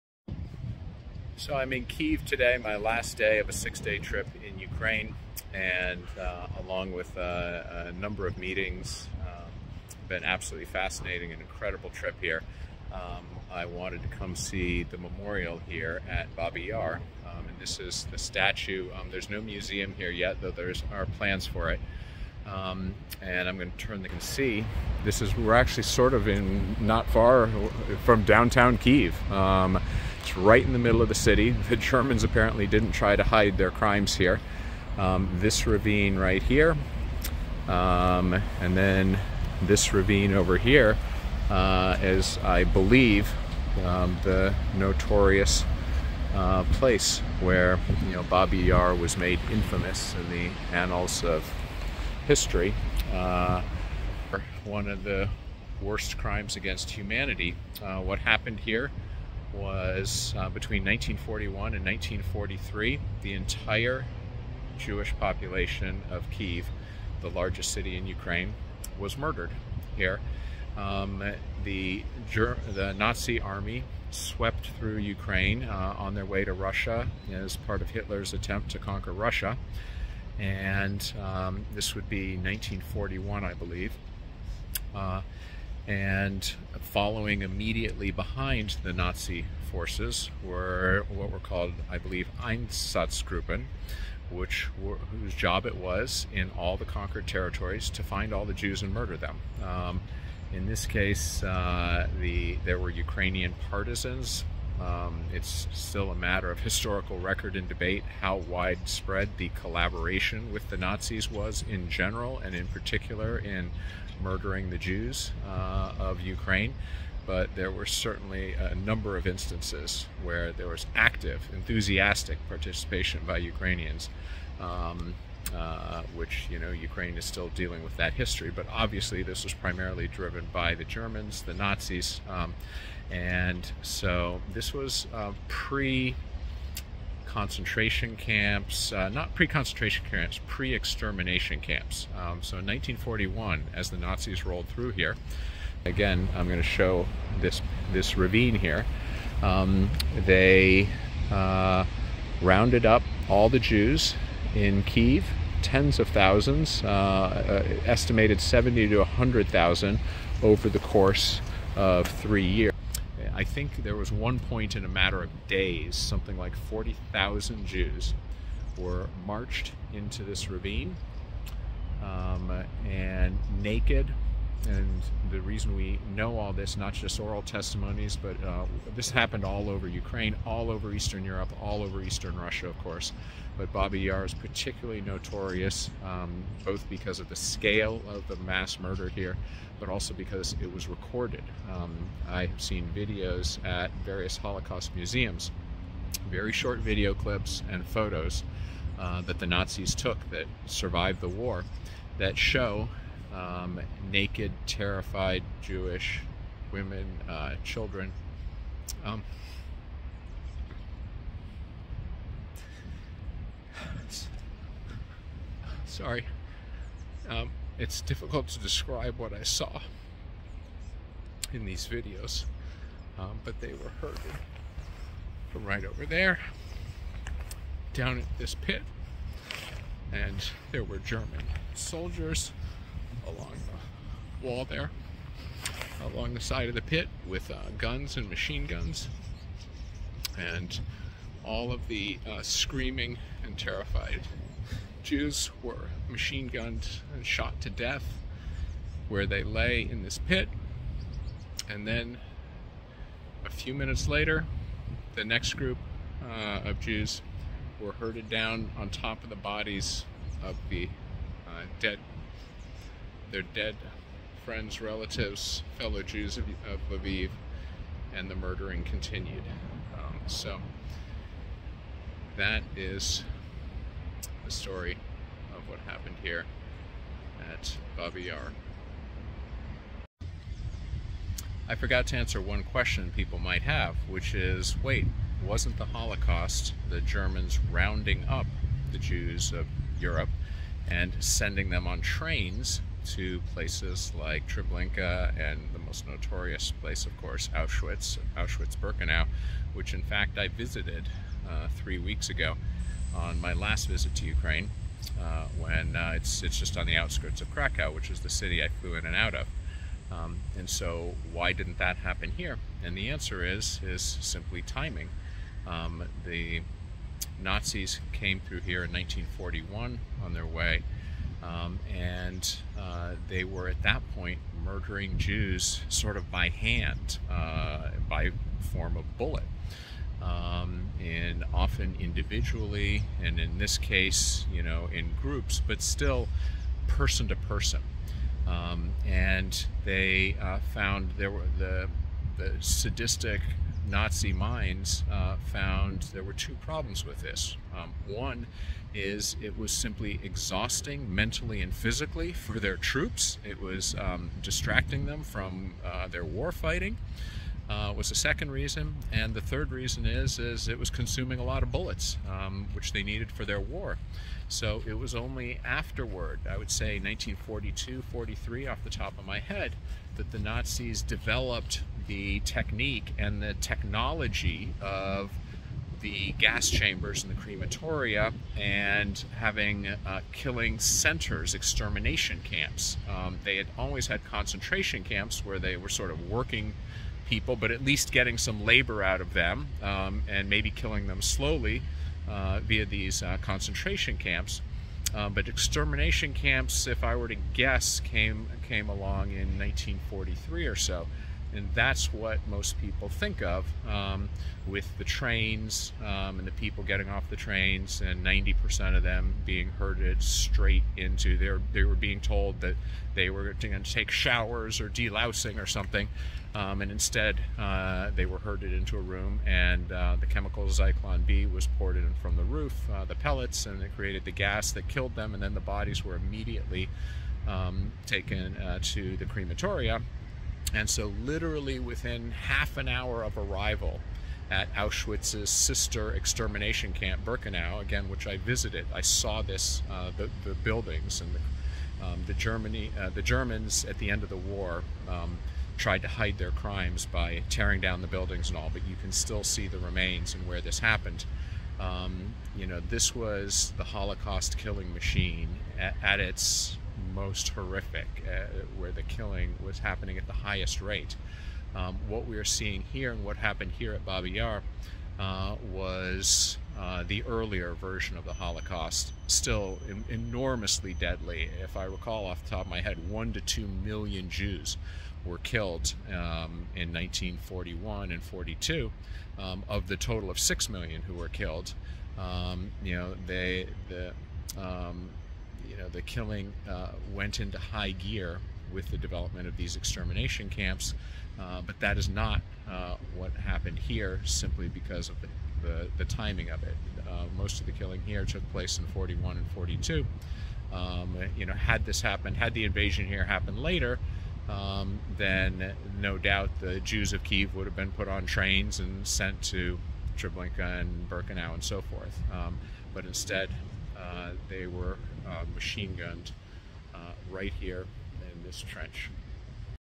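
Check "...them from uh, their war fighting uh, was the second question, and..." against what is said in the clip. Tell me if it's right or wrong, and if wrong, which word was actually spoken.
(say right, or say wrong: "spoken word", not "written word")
wrong: "reason", not "question".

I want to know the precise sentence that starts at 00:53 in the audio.
Uh, one of the worst crimes against humanity.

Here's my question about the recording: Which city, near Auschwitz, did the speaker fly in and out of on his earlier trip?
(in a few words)
Krakow.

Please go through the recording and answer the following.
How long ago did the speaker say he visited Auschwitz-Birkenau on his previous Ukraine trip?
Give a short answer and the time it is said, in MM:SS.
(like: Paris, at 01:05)
Three weeks ago, at 05:01.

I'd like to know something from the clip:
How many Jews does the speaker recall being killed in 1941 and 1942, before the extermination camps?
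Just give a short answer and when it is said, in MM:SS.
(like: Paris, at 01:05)
1 to 2 million, at 07:53.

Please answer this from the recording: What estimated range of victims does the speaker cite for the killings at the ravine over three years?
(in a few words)
70 to 100,000.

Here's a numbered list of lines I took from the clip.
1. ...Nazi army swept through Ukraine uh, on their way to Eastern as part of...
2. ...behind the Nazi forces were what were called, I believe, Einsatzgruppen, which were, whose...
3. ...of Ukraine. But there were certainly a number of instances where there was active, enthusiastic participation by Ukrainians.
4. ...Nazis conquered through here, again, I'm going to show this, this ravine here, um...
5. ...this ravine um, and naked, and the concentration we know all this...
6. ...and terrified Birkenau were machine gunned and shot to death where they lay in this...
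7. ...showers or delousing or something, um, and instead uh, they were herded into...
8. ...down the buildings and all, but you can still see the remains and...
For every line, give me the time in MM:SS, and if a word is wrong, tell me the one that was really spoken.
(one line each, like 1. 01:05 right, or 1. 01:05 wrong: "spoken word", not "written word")
1. 01:12 wrong: "Russia", not "Eastern"
2. 01:28 right
3. 01:55 right
4. 02:23 wrong: "rolled", not "conquered"
5. 02:50 wrong: "reason", not "concentration"
6. 04:03 wrong: "Jews", not "Birkenau"
7. 06:54 right
8. 07:27 right.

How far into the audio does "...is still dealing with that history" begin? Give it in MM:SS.
02:07.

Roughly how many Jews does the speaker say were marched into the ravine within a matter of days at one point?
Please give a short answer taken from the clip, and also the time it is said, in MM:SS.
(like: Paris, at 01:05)
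40,000, at 02:46.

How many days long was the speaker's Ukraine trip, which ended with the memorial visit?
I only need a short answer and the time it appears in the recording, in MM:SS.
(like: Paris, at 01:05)
6, at 00:03.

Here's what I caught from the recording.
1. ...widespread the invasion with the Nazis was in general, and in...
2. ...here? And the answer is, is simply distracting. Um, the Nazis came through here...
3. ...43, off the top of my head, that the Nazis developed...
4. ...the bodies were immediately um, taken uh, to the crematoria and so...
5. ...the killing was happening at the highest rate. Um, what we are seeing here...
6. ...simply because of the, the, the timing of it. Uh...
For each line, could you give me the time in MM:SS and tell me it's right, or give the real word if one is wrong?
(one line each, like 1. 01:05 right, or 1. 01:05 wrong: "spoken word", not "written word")
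1. 01:48 wrong: "collaboration", not "invasion"
2. 05:12 wrong: "timing", not "distracting"
3. 06:08 right
4. 07:05 right
5. 07:38 right
6. 08:14 right.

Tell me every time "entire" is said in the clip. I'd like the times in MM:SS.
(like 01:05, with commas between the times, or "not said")
01:03.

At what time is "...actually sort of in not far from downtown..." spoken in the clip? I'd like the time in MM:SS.
00:25.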